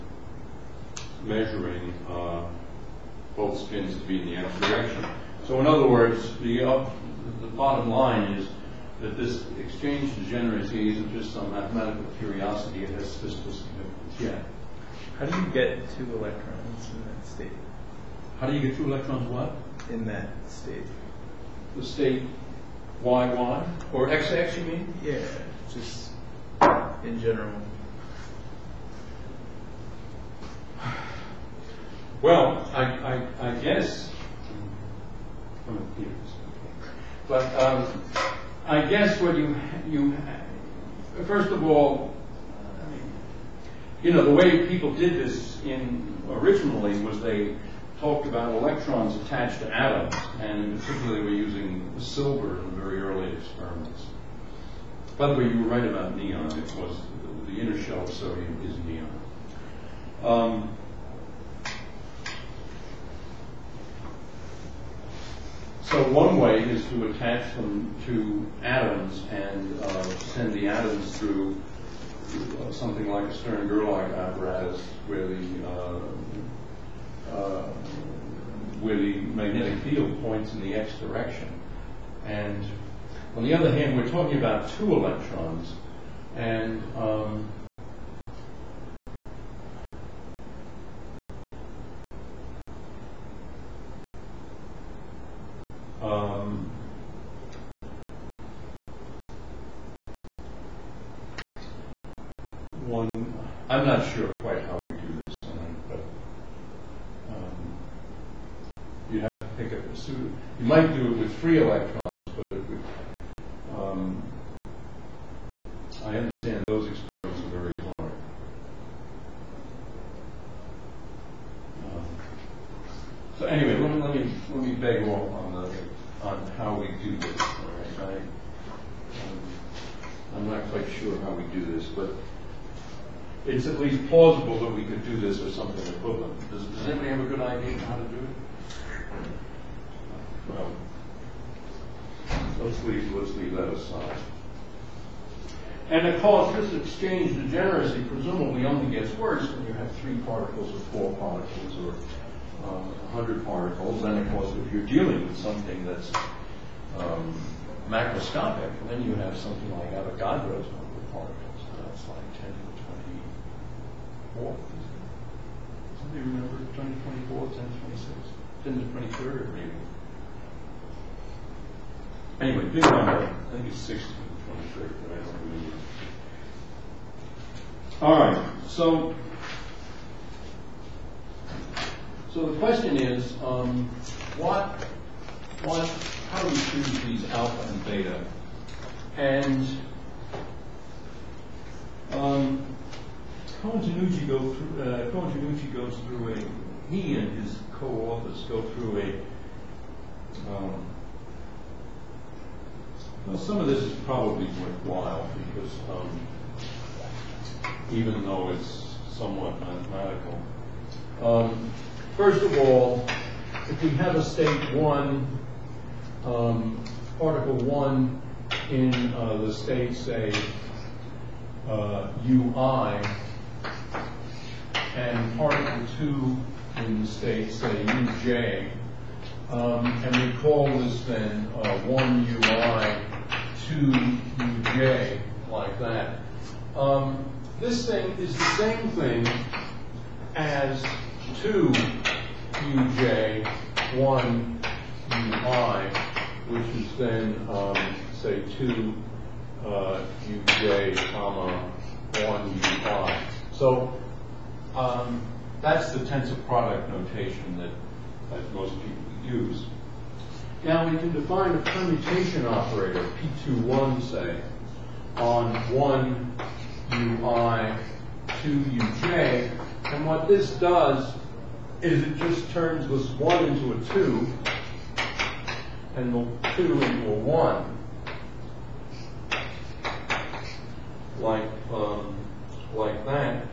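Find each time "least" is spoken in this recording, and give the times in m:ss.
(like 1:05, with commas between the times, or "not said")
2:13.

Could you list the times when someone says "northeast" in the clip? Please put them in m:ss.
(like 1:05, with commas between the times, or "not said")
not said.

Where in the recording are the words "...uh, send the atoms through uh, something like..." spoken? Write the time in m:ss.
1:09.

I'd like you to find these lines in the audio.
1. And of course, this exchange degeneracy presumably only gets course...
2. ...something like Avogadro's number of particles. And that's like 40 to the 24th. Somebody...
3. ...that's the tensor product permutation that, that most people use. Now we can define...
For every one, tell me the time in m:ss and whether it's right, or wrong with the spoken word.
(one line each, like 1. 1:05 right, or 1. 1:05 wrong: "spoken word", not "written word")
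1. 2:25 wrong: "worse", not "course"
2. 2:39 wrong: "10", not "40"
3. 4:15 wrong: "notation", not "permutation".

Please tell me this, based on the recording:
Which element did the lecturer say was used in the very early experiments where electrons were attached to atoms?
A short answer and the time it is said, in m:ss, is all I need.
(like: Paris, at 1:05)
Silver, at 0:51.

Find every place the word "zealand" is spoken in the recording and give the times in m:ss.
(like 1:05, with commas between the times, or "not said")
not said.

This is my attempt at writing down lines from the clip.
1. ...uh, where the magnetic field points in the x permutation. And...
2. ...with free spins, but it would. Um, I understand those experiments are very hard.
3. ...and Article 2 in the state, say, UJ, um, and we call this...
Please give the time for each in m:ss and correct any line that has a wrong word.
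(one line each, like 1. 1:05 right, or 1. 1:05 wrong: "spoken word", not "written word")
1. 1:17 wrong: "direction", not "permutation"
2. 1:51 wrong: "electrons", not "spins"
3. 3:44 right.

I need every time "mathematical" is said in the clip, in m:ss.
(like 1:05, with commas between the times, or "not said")
0:11, 3:29.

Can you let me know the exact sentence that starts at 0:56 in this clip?
It was the inner shell of sodium is neon.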